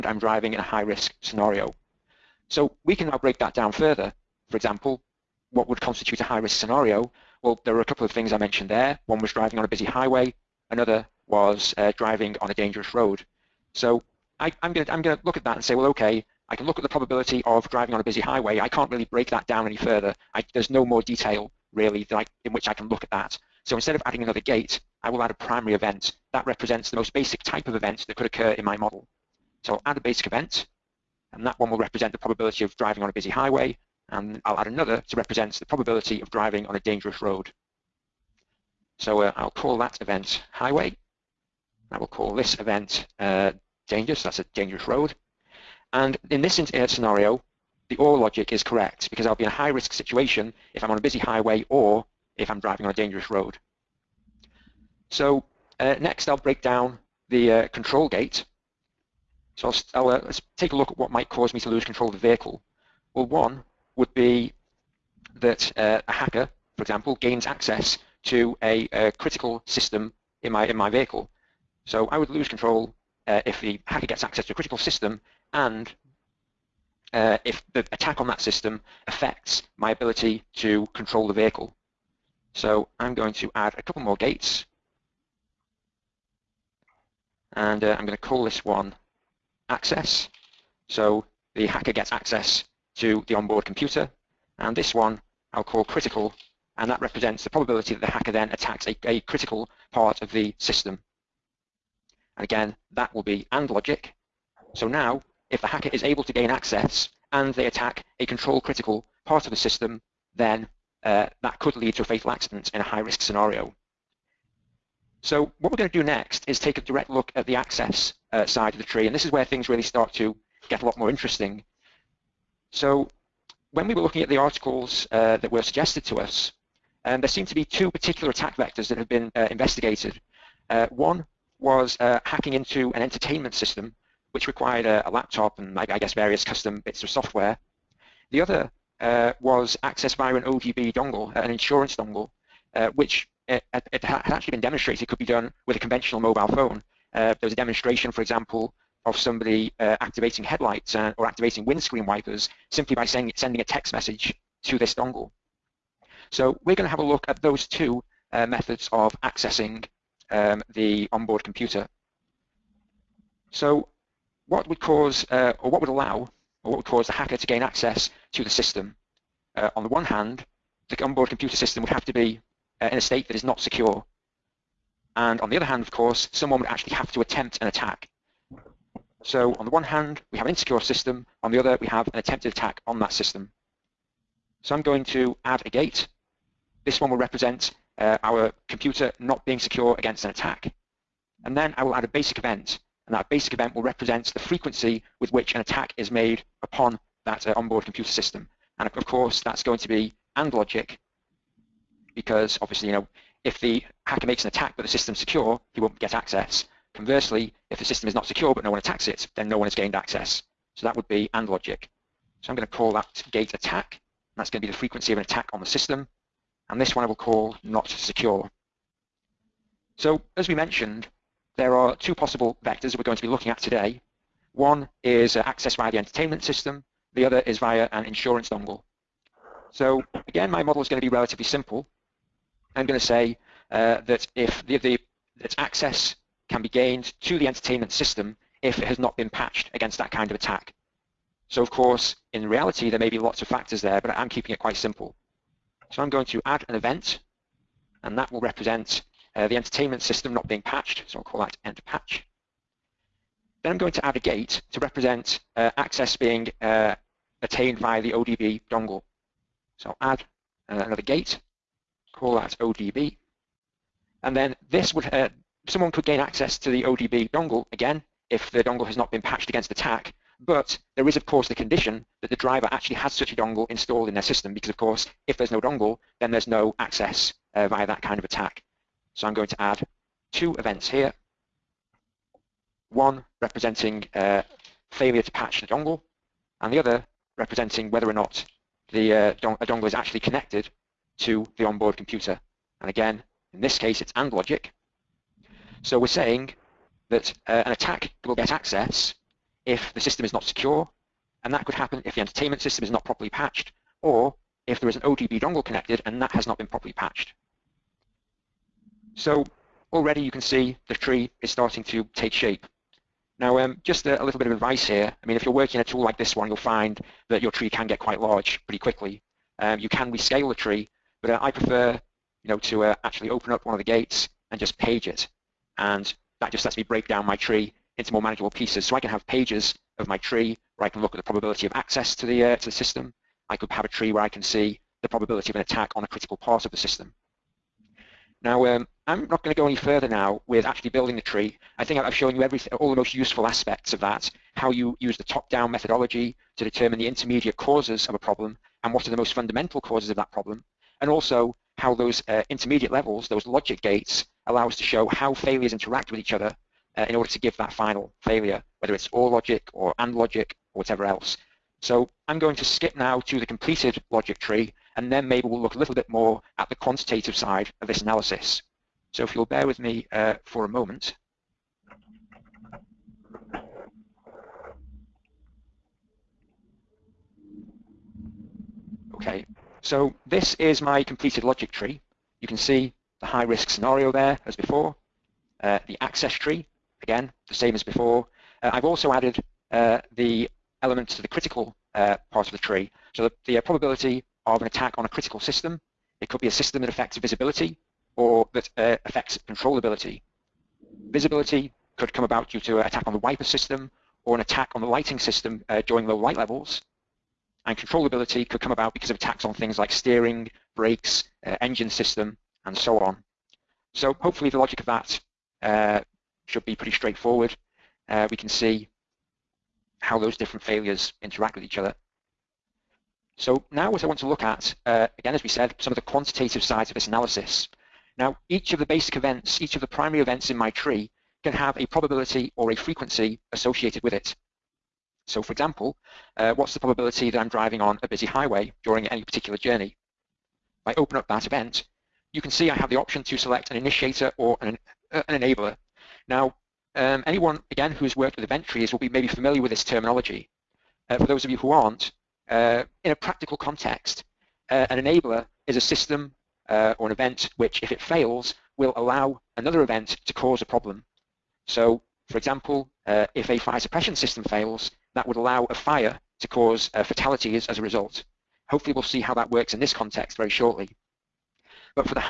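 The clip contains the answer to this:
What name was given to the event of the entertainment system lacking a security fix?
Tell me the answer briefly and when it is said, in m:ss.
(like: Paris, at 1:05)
end patch, at 4:11.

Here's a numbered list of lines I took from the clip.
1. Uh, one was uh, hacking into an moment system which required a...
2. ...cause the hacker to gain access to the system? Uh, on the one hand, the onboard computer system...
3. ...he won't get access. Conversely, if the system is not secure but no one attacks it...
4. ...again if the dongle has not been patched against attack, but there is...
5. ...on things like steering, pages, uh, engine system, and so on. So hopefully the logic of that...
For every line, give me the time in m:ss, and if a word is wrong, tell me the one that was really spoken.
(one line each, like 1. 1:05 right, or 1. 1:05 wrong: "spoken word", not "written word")
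1. 2:10 wrong: "entertainment", not "moment"
2. 2:46 right
3. 3:25 right
4. 4:27 right
5. 6:49 wrong: "brakes", not "pages".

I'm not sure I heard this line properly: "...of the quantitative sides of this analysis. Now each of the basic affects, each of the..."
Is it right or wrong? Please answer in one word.
wrong.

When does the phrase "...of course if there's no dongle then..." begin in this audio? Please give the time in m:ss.
4:34.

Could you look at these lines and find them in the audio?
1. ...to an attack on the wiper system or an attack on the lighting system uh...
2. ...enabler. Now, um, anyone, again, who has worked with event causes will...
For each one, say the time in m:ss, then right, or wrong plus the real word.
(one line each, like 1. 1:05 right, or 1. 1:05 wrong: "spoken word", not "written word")
1. 6:42 right
2. 7:25 wrong: "trees", not "causes".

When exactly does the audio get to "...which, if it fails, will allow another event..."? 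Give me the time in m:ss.
7:37.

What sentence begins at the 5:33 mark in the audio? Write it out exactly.
I could have a tree where I can see the probability of an attack on a critical part of the system.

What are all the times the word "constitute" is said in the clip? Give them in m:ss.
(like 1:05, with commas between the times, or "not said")
0:05.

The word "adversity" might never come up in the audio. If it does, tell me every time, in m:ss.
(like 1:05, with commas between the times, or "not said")
not said.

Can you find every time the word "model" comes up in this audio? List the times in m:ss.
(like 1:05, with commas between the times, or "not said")
0:28, 3:50.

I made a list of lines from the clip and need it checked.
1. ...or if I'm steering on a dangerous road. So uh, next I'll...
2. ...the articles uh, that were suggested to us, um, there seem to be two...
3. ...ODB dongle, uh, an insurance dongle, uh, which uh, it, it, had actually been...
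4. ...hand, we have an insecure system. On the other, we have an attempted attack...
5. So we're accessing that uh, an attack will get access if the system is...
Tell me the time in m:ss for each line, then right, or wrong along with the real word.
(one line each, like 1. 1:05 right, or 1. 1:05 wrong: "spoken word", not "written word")
1. 0:51 wrong: "driving", not "steering"
2. 2:04 right
3. 2:20 right
4. 2:59 right
5. 4:55 wrong: "saying", not "accessing".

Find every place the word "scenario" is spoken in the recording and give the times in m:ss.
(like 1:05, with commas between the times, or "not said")
0:01, 0:06, 0:46, 1:53, 6:23.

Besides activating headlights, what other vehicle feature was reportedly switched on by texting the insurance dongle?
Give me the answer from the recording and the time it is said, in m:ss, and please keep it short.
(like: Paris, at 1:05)
Windscreen wipers, at 2:31.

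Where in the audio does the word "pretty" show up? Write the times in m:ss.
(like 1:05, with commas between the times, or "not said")
5:18, 6:56.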